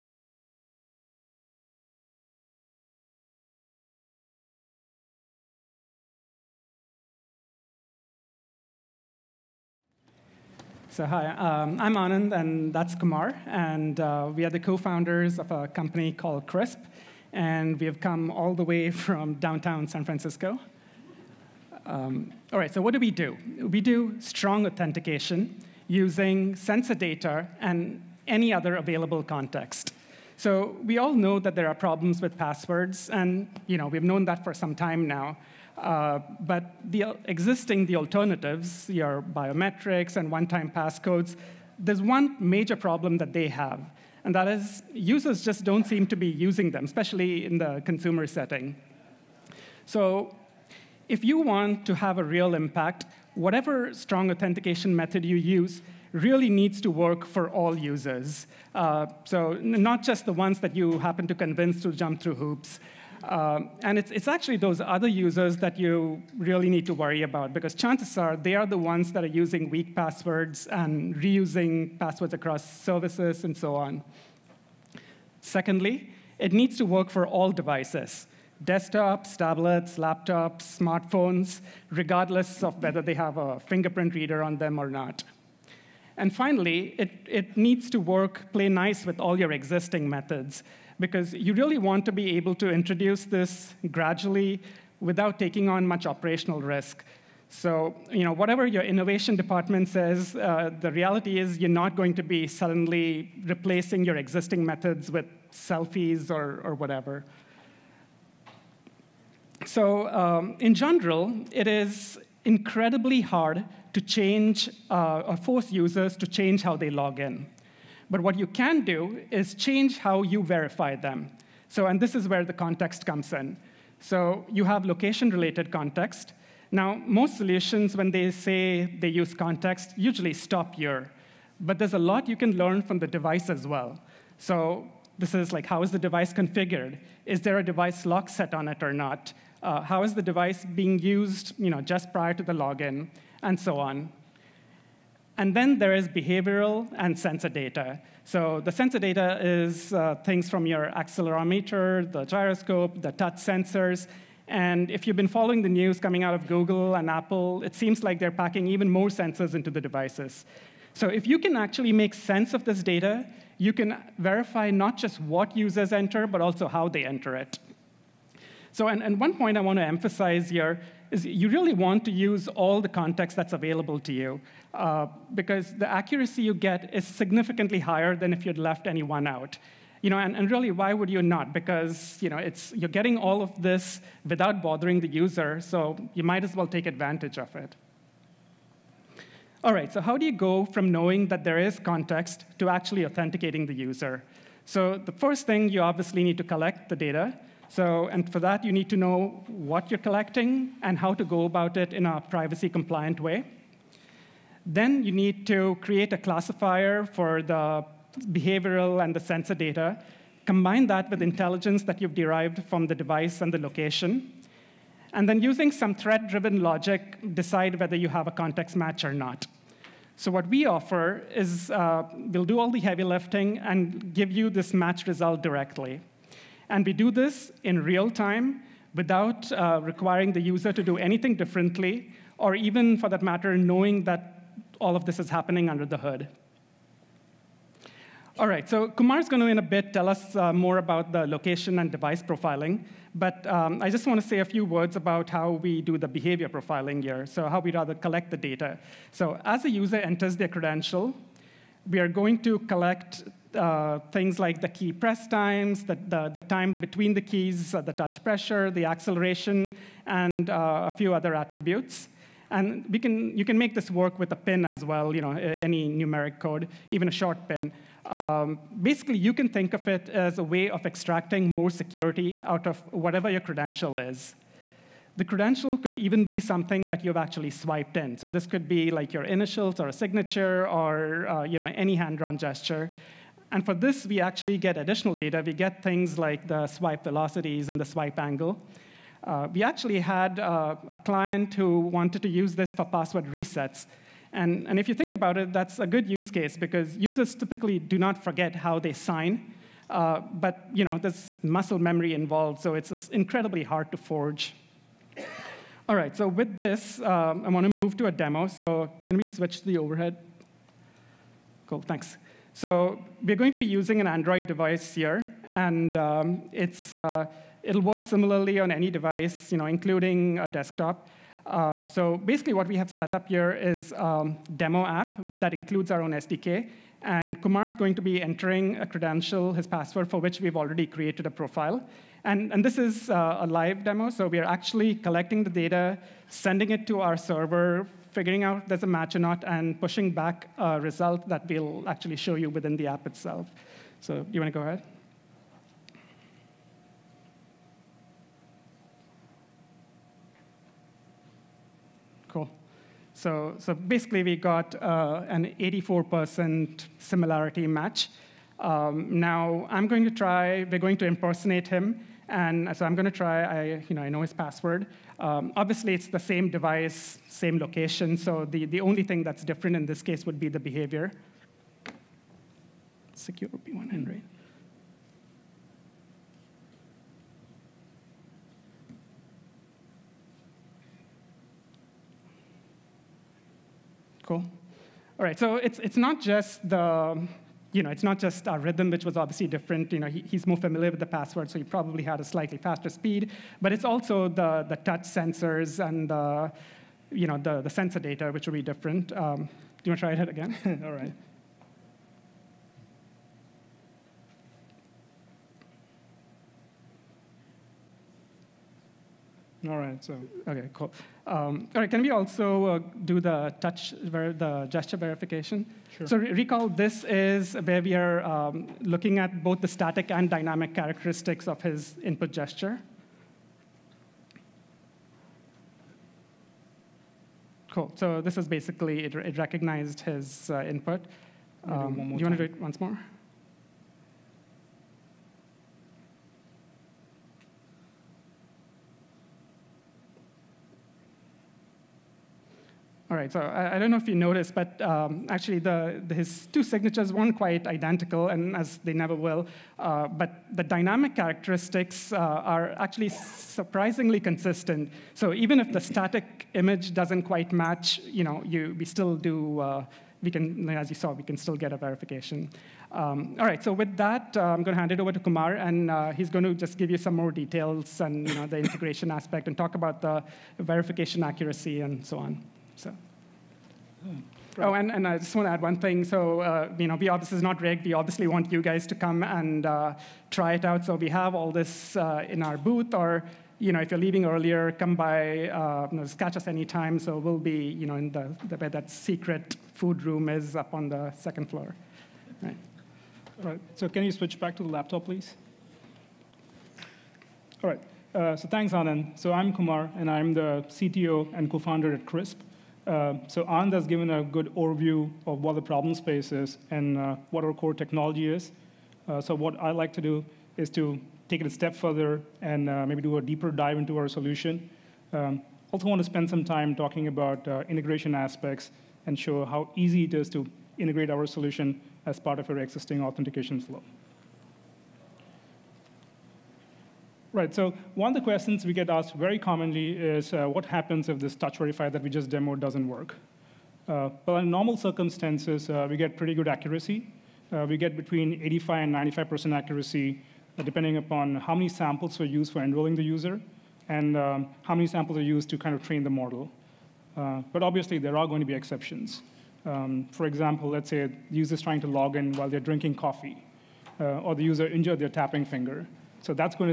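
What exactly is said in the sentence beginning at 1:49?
So, um, in general, it is incredibly hard to change uh, or force users to change how they log in.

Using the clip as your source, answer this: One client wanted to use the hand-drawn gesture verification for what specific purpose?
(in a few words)
password resets.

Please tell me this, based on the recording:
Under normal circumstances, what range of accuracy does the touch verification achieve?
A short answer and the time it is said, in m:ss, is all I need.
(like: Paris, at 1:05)
85 to 95%, at 8:57.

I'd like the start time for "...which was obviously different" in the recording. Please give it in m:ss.
6:28.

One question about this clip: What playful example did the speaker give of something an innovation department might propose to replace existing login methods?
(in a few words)
selfies.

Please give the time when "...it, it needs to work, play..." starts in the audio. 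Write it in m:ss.
1:26.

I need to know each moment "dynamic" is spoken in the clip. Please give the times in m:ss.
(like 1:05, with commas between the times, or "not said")
7:00, 7:30.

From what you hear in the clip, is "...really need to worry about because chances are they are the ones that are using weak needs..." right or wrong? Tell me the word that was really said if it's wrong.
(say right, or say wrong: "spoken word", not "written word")
wrong: "passwords", not "needs".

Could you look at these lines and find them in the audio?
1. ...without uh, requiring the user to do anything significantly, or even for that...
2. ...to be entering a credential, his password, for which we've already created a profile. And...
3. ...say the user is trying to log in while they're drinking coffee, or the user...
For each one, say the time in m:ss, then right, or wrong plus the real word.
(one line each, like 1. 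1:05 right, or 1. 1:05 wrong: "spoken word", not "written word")
1. 3:48 wrong: "differently", not "significantly"
2. 5:27 right
3. 9:10 right.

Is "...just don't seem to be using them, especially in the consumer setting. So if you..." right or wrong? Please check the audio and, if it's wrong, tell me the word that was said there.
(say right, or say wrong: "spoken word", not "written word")
right.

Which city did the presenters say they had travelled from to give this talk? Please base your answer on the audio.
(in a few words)
San Francisco.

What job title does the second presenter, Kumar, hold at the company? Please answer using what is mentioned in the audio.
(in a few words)
CTO.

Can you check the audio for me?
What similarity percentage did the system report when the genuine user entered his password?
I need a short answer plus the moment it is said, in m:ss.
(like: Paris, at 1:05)
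84%, at 5:55.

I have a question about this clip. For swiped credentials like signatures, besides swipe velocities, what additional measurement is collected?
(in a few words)
swipe angle.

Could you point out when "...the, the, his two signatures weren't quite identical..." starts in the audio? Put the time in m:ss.
7:25.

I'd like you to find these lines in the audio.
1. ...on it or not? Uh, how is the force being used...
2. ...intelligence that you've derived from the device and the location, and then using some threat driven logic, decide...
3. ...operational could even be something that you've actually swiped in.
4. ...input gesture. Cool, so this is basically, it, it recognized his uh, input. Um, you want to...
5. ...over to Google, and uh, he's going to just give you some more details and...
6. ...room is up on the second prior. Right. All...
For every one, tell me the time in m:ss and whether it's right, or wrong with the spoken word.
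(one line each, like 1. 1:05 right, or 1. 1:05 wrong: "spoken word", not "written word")
1. 2:18 wrong: "device", not "force"
2. 3:31 right
3. 4:35 wrong: "credential", not "operational"
4. 7:02 right
5. 7:44 wrong: "Kumar", not "Google"
6. 8:10 wrong: "floor", not "prior".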